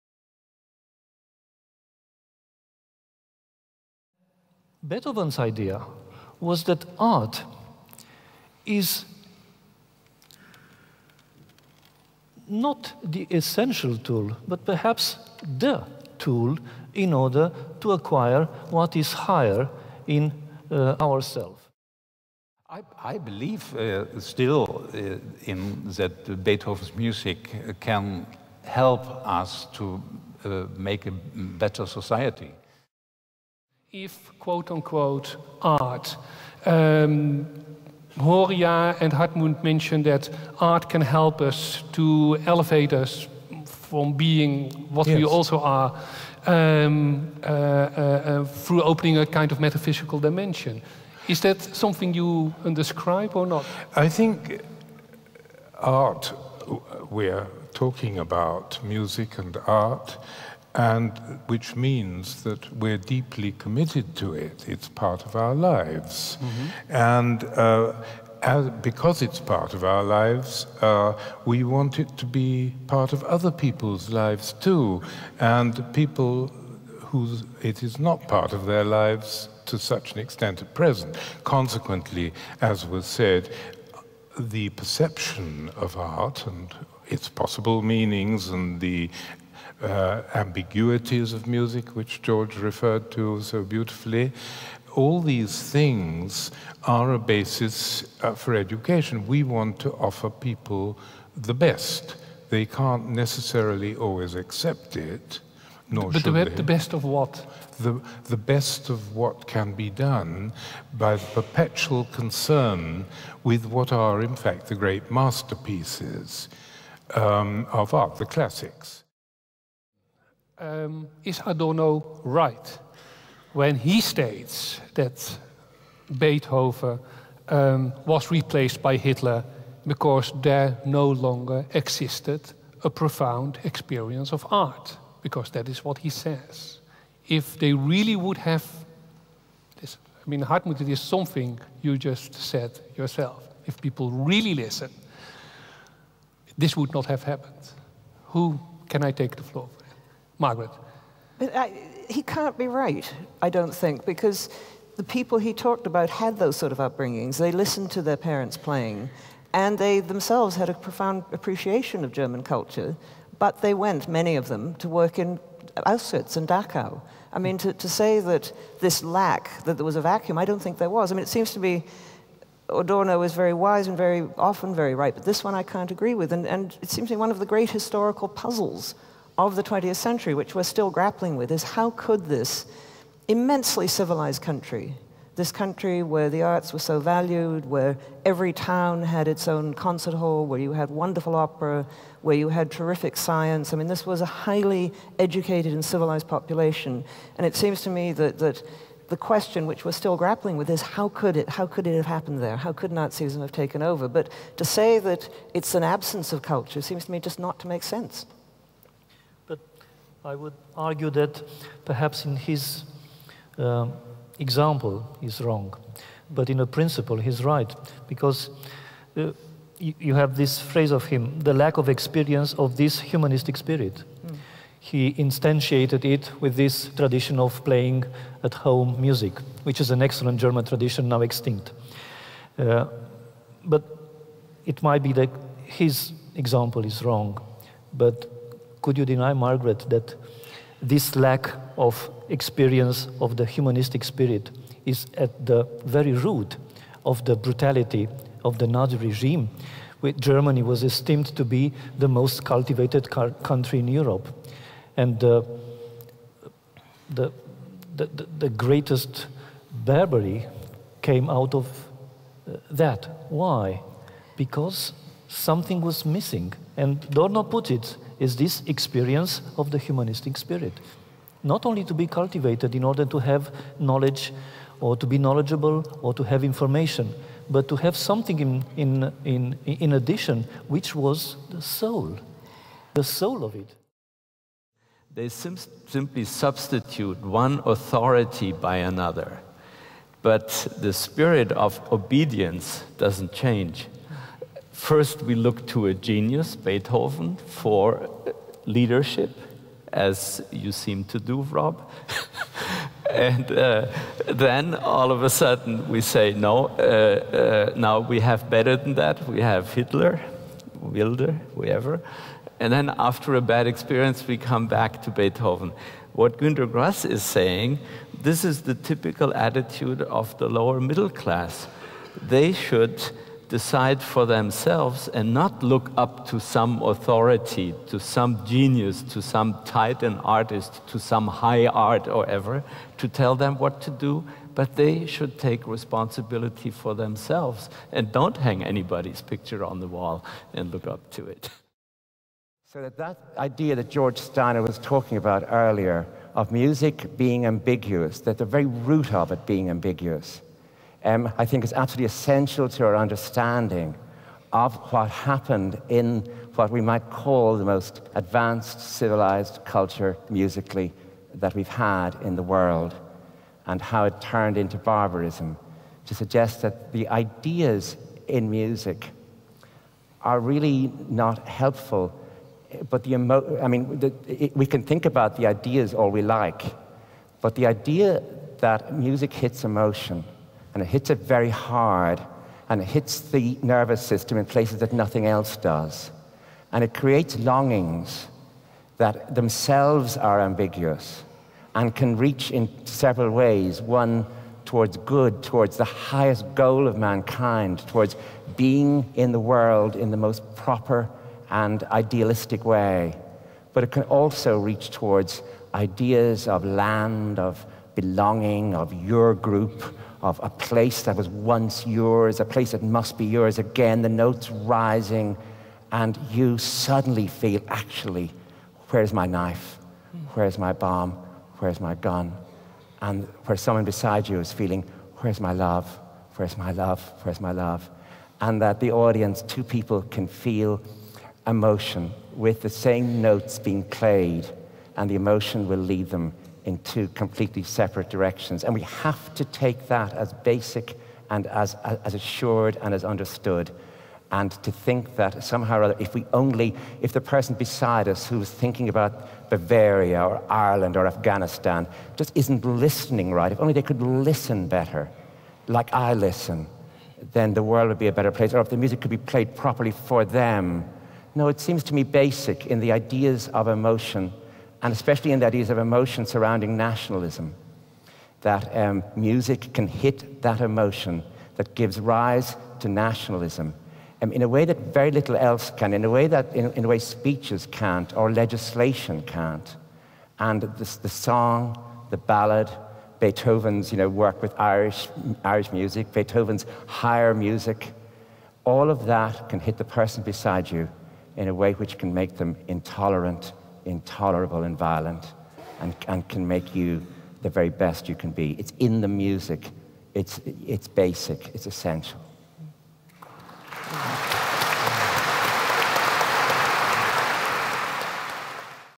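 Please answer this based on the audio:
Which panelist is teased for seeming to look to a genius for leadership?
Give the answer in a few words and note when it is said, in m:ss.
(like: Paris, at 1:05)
Rob, at 5:01.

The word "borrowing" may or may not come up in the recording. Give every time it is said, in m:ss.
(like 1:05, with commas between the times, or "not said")
not said.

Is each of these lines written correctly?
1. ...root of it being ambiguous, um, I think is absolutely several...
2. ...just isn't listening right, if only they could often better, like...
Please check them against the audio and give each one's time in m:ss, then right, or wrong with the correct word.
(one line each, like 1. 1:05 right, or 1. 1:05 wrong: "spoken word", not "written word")
1. 5:48 wrong: "essential", not "several"
2. 7:32 wrong: "listen", not "often".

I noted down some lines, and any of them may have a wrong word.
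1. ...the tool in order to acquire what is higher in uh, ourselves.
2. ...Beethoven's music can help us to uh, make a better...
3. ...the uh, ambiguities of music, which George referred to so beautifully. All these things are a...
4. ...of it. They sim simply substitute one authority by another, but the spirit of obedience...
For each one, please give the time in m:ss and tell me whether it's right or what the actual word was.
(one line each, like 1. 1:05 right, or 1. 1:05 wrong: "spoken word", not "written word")
1. 0:15 right
2. 0:26 right
3. 1:28 right
4. 4:43 right.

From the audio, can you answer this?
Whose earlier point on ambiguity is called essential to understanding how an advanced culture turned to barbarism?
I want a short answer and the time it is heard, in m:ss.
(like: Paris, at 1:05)
George Steiner, at 5:43.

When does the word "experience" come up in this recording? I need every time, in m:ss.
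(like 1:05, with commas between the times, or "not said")
2:13, 3:41, 4:02, 4:28, 5:13.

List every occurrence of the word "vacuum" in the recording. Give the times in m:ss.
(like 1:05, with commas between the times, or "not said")
2:50.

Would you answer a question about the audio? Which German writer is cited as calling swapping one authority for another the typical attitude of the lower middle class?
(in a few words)
Günter Grass.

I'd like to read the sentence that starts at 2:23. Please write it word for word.
If people really listen, this would not have happened.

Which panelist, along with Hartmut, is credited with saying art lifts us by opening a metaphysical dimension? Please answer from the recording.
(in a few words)
Horia.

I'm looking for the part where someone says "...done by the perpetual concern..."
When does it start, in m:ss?
1:49.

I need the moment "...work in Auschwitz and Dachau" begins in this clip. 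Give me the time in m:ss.
2:44.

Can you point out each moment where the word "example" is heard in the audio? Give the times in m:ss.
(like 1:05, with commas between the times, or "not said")
3:34, 3:56.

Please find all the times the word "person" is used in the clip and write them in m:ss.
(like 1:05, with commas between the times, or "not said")
7:27, 8:09.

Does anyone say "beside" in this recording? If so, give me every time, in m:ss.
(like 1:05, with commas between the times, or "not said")
7:03, 7:27, 8:10.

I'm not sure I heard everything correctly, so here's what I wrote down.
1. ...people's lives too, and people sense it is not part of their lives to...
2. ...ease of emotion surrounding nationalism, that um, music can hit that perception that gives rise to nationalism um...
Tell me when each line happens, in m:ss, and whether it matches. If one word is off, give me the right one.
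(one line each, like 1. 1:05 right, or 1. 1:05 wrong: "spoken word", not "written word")
1. 1:13 wrong: "whose", not "sense"
2. 7:45 wrong: "emotion", not "perception".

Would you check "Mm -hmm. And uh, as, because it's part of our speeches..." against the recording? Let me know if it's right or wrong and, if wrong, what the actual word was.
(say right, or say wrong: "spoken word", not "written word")
wrong: "lives", not "speeches".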